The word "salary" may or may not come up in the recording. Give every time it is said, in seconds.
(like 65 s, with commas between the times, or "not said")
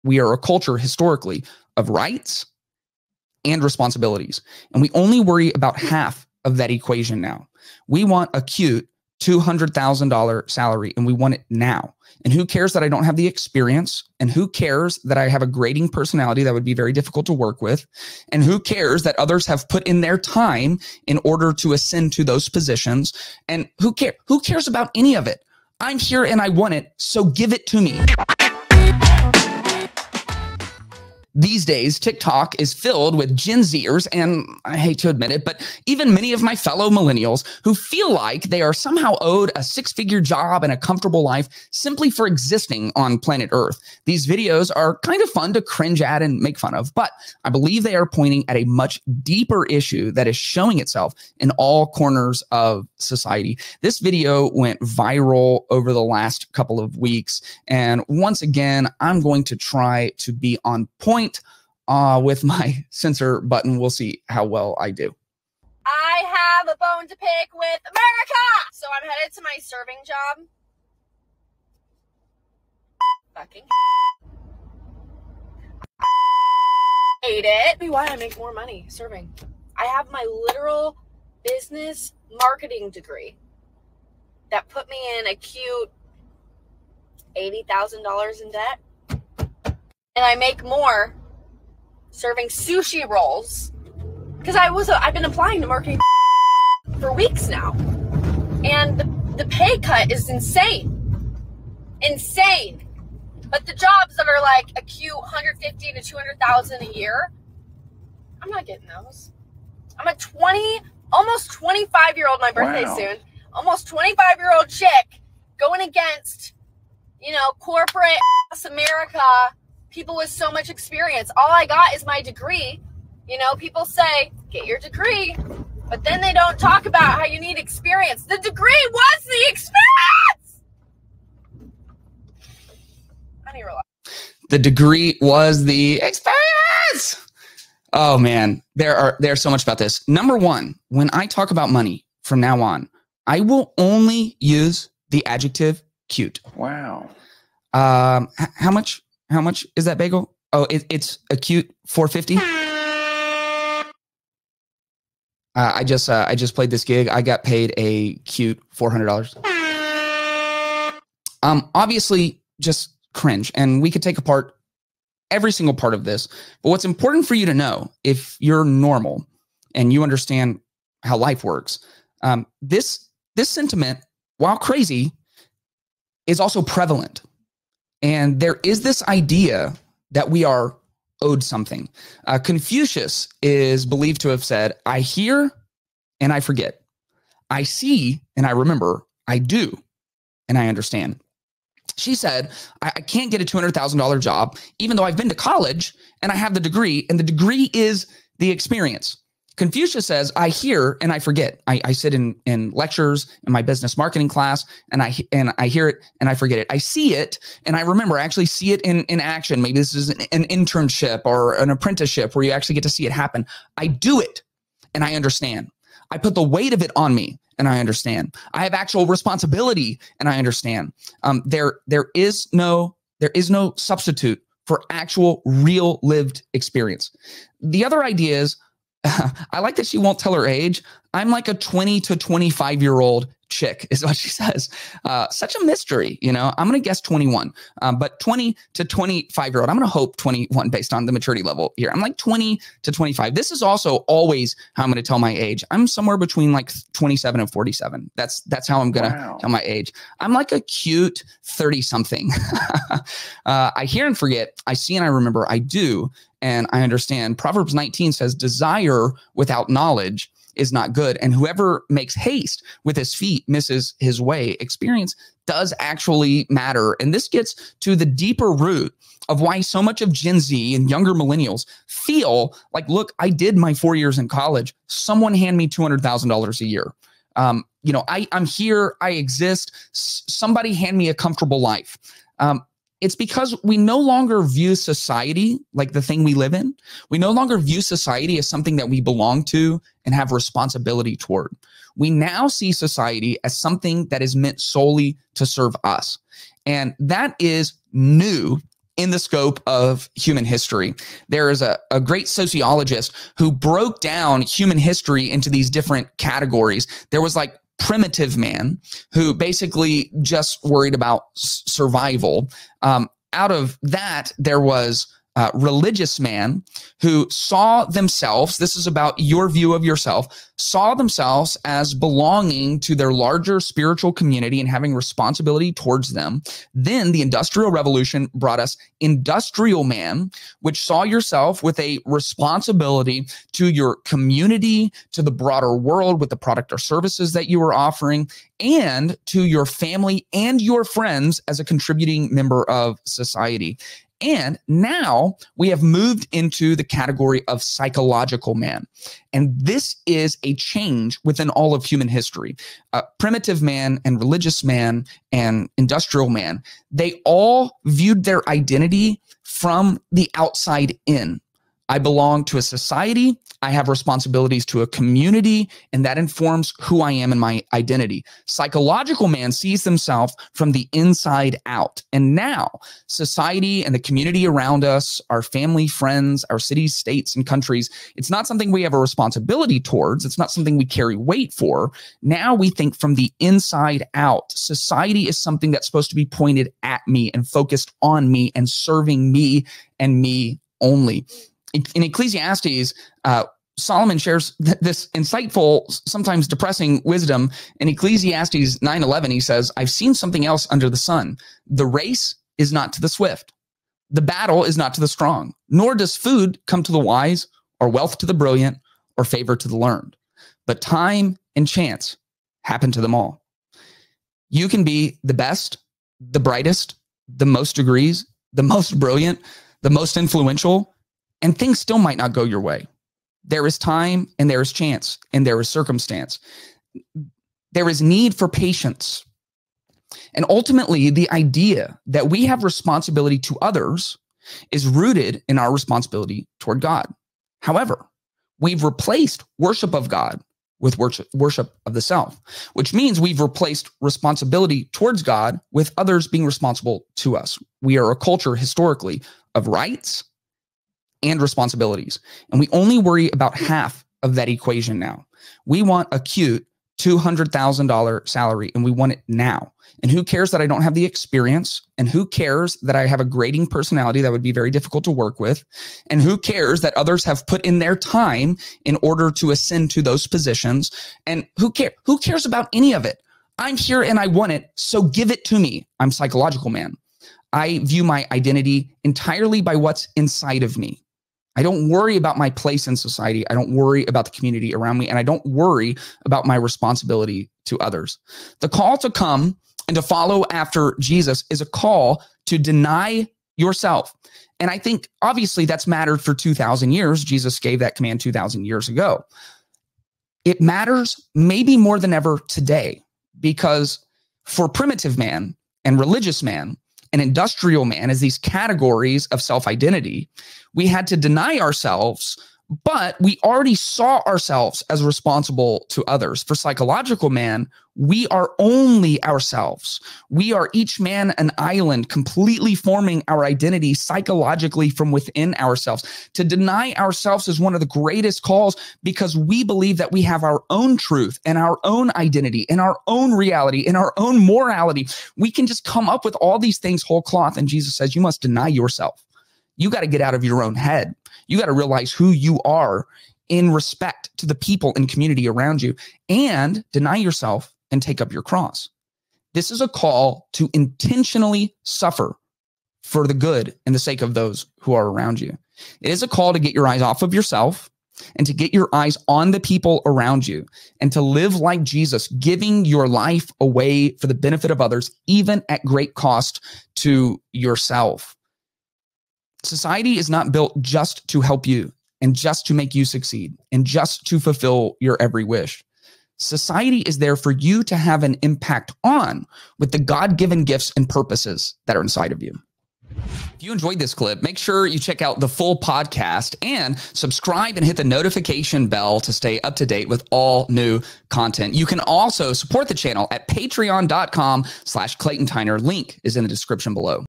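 10 s, 458 s.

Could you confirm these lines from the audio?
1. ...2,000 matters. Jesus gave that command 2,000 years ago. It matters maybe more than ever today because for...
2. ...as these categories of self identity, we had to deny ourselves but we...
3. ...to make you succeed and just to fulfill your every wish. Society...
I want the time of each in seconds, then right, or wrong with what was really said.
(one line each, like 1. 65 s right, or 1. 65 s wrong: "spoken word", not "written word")
1. 496 s wrong: "years", not "matters"
2. 508 s right
3. 572 s right.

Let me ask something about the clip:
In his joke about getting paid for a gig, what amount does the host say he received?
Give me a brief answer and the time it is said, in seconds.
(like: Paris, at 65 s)
$400, at 158 s.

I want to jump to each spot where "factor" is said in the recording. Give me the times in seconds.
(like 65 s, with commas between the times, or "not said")
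not said.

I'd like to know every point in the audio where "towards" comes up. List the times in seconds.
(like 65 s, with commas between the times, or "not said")
291 s, 325 s, 379 s, 436 s, 444 s.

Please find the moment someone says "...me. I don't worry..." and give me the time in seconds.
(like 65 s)
480 s.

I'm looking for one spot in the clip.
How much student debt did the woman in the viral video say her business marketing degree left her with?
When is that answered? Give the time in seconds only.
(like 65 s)
87 s.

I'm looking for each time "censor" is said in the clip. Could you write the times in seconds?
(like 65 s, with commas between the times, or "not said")
62 s.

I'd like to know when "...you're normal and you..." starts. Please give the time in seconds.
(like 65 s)
168 s.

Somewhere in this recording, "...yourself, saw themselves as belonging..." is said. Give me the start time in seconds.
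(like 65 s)
319 s.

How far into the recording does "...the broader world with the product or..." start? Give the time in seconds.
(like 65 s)
335 s.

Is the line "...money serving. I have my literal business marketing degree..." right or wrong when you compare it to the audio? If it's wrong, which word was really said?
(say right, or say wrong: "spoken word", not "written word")
right.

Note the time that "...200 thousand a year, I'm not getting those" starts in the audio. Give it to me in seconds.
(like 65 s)
106 s.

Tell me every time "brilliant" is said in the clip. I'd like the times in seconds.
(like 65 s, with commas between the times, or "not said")
408 s, 418 s.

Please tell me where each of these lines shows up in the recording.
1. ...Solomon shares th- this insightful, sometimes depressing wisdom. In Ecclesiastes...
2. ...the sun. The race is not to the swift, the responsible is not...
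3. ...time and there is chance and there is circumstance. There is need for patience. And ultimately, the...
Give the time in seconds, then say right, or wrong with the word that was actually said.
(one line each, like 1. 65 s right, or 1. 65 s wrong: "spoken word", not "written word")
1. 393 s right
2. 400 s wrong: "battle", not "responsible"
3. 423 s right.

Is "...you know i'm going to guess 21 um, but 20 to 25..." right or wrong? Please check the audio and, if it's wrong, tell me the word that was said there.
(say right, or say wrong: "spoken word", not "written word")
right.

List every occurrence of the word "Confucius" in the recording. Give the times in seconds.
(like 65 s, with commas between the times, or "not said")
182 s, 199 s.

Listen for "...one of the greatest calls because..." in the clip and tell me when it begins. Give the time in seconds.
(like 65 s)
527 s.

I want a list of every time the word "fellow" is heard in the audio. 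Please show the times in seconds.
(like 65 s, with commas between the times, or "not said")
36 s.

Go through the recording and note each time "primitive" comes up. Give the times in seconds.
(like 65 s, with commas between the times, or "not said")
307 s, 353 s, 504 s.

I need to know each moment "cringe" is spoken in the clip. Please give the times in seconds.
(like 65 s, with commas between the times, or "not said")
45 s, 163 s.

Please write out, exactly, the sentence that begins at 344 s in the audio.
And now we have moved into the category of psychological man.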